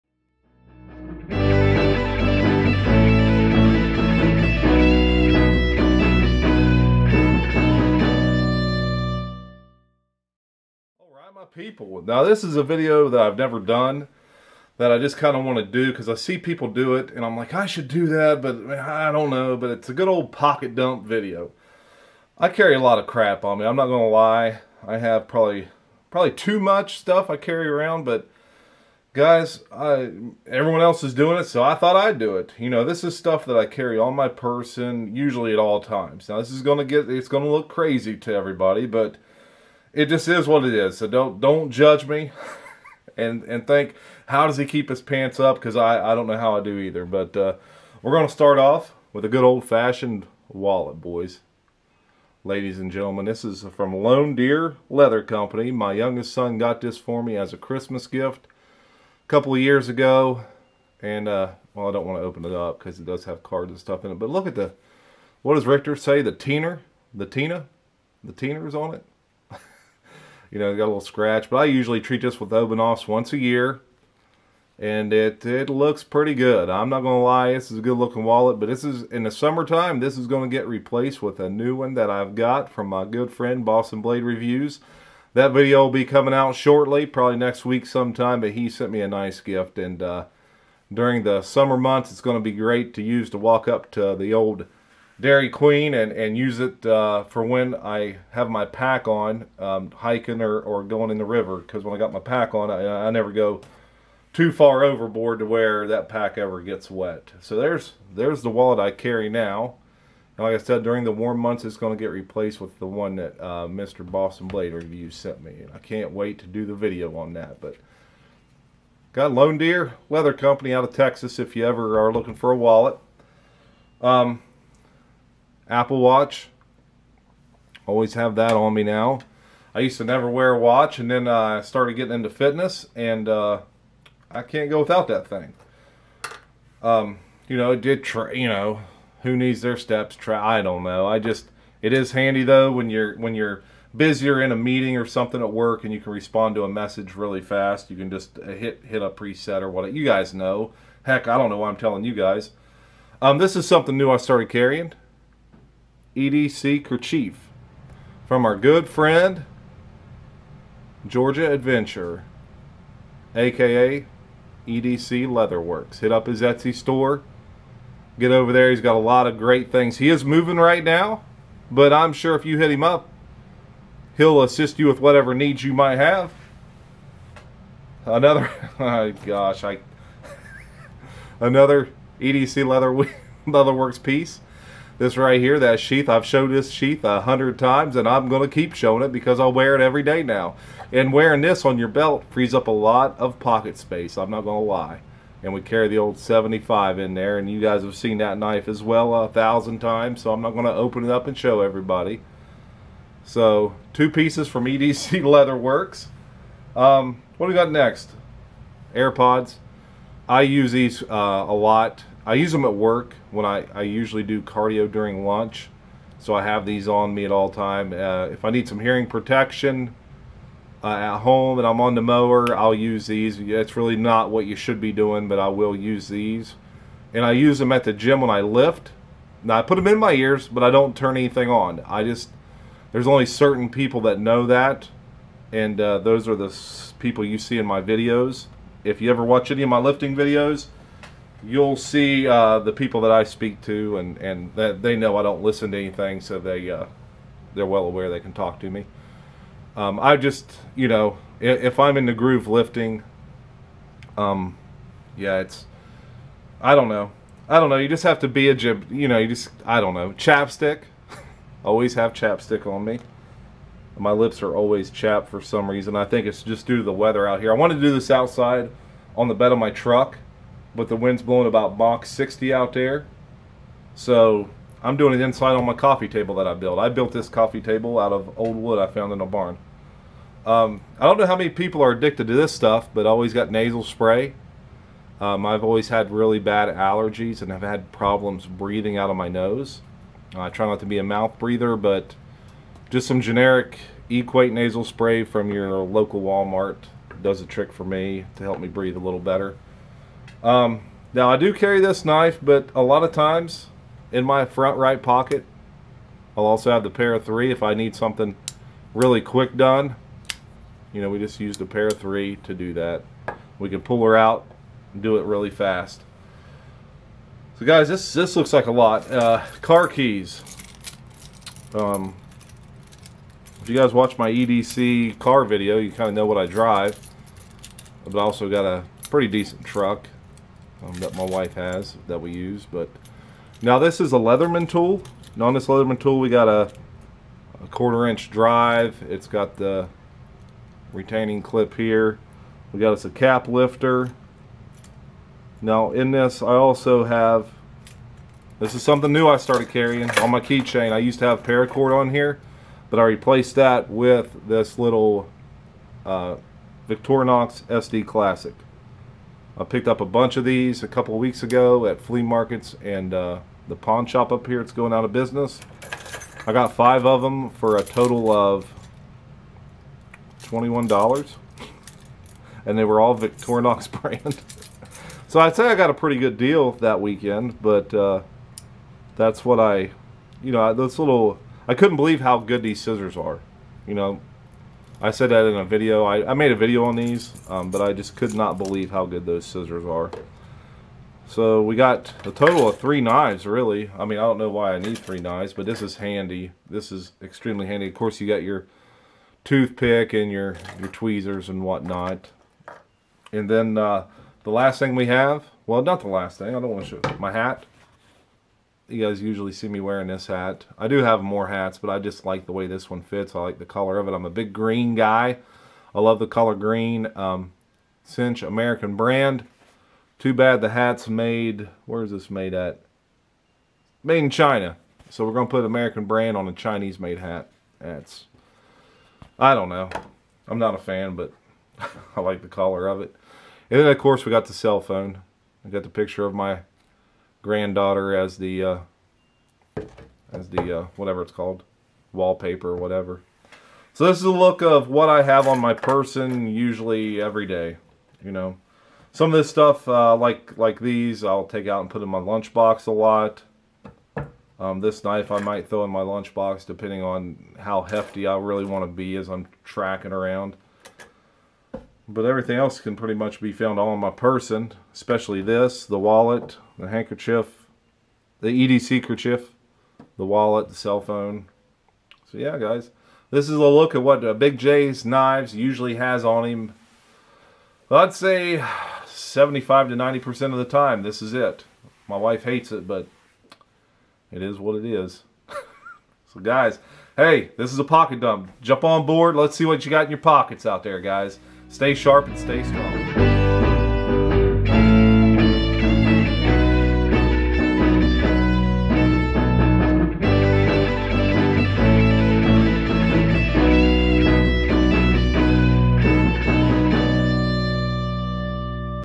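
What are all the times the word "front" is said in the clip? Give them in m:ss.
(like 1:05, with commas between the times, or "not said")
5:04.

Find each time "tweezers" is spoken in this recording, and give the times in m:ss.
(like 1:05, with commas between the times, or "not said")
6:40.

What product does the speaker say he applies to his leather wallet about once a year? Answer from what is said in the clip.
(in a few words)
Obenauf's.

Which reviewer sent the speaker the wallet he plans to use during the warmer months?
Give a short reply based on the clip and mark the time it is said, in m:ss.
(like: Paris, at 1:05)
Boston Blade Reviews, at 1:23.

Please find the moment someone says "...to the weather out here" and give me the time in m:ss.
4:26.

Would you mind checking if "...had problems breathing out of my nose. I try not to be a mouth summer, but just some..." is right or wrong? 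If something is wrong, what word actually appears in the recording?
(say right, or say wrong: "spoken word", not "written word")
wrong: "breather", not "summer".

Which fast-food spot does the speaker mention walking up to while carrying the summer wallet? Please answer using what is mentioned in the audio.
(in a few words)
Dairy Queen.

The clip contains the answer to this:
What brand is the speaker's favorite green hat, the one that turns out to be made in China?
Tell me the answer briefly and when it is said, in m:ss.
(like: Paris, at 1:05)
Cinch, at 6:58.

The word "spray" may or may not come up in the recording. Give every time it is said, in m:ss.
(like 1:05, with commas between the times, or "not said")
4:43, 4:54.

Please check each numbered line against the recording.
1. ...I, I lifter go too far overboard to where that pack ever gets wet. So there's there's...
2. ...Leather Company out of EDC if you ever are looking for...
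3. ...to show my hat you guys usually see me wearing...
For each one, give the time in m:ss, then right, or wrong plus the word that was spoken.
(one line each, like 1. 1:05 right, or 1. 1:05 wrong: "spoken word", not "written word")
1. 1:42 wrong: "never", not "lifter"
2. 2:00 wrong: "Texas", not "EDC"
3. 6:46 right.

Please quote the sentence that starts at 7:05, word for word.
So we're going to put American brand on a Chinese made hat.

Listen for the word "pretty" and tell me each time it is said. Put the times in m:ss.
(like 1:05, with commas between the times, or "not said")
1:16, 5:29, 6:15, 7:42.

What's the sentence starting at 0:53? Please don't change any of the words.
This is from Lone Deer Leather Company.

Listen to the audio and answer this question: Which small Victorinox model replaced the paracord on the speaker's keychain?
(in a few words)
SD Classic.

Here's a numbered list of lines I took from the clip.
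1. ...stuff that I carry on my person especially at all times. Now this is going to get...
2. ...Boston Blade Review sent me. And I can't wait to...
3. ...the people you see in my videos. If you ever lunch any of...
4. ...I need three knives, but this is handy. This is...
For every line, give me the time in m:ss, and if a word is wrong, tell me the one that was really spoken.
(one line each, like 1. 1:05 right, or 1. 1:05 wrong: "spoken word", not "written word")
1. 0:33 wrong: "usually", not "especially"
2. 1:54 right
3. 3:56 wrong: "watch", not "lunch"
4. 6:34 right.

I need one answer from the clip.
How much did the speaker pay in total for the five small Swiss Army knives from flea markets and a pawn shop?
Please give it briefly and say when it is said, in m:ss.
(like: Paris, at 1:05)
$21, at 6:10.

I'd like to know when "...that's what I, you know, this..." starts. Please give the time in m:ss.
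6:19.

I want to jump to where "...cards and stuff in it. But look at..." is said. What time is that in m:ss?
1:03.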